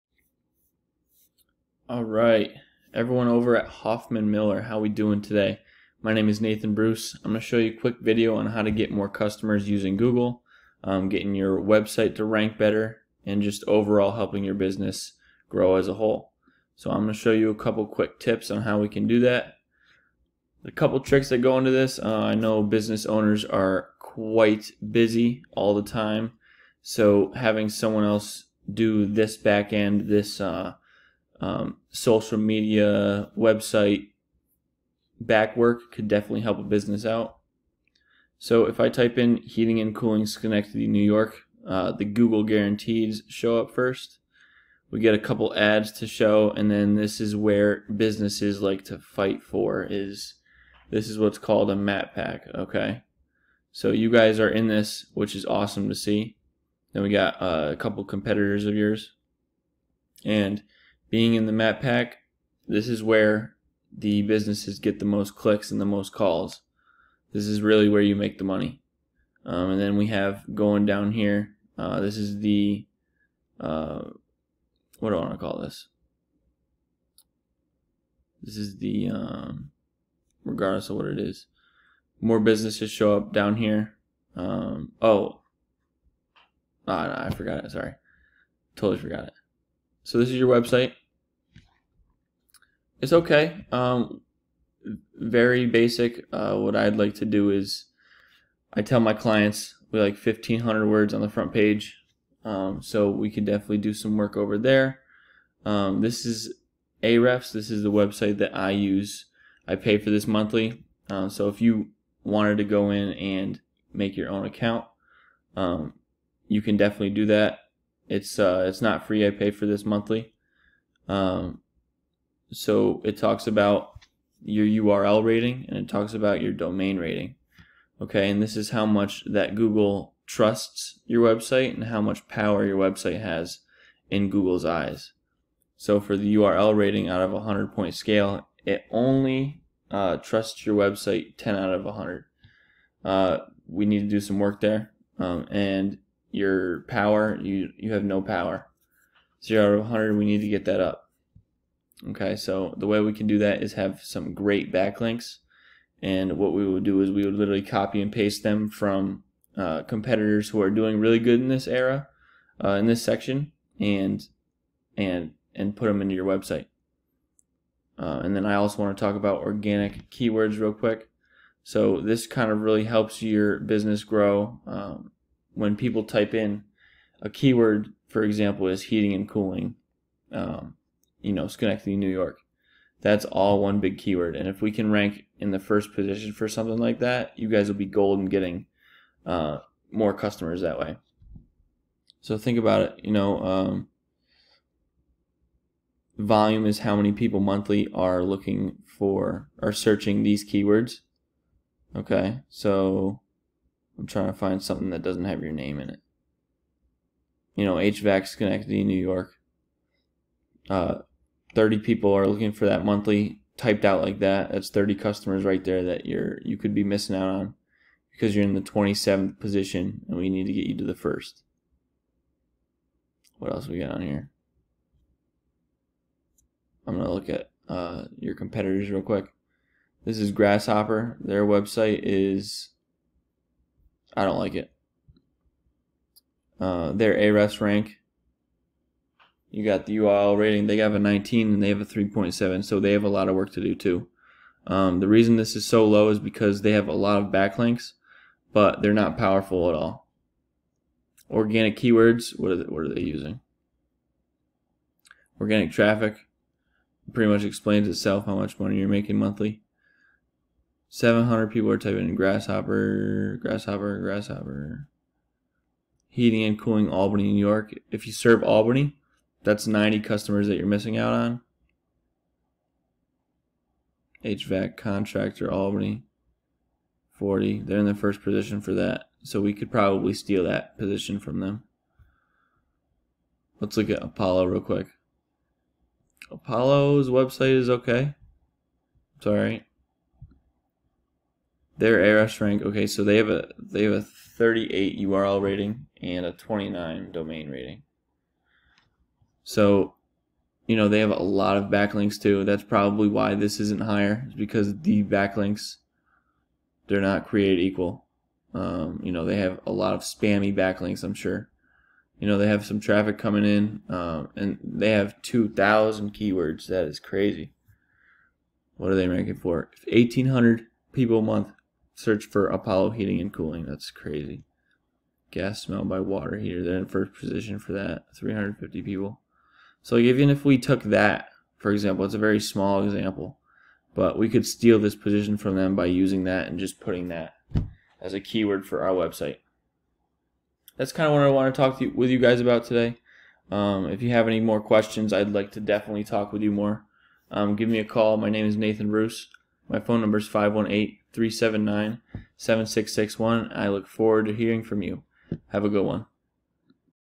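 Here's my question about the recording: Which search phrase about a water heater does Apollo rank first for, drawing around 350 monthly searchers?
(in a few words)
Gas smell by water heater.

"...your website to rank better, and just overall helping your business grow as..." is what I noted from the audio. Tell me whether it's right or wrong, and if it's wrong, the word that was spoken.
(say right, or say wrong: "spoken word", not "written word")
right.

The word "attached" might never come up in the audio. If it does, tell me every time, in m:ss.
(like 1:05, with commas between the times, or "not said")
not said.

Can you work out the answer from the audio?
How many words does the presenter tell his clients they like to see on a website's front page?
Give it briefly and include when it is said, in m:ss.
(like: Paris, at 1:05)
1500, at 1:40.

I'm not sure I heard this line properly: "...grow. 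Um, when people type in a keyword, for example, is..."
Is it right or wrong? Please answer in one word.
right.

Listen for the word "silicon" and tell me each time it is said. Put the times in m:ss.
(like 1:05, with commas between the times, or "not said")
not said.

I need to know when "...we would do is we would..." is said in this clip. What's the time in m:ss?
2:36.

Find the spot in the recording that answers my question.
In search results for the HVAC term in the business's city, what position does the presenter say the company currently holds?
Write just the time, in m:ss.
3:38.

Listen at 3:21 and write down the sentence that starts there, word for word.
Okay, so I'm trying to find something that doesn't have your name in it.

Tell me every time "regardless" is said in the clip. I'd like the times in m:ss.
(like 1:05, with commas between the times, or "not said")
1:20.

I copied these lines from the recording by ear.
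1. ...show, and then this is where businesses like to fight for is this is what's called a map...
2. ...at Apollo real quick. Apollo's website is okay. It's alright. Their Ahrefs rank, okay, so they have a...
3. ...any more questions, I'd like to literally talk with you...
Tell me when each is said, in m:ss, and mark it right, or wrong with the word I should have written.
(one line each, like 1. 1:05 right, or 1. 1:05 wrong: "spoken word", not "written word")
1. 0:46 right
2. 4:43 right
3. 5:44 wrong: "definitely", not "literally".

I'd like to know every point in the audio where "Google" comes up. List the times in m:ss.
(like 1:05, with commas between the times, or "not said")
0:09, 0:42, 2:09, 2:14.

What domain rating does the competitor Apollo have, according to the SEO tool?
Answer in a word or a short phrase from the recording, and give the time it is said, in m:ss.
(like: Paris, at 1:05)
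29, at 4:56.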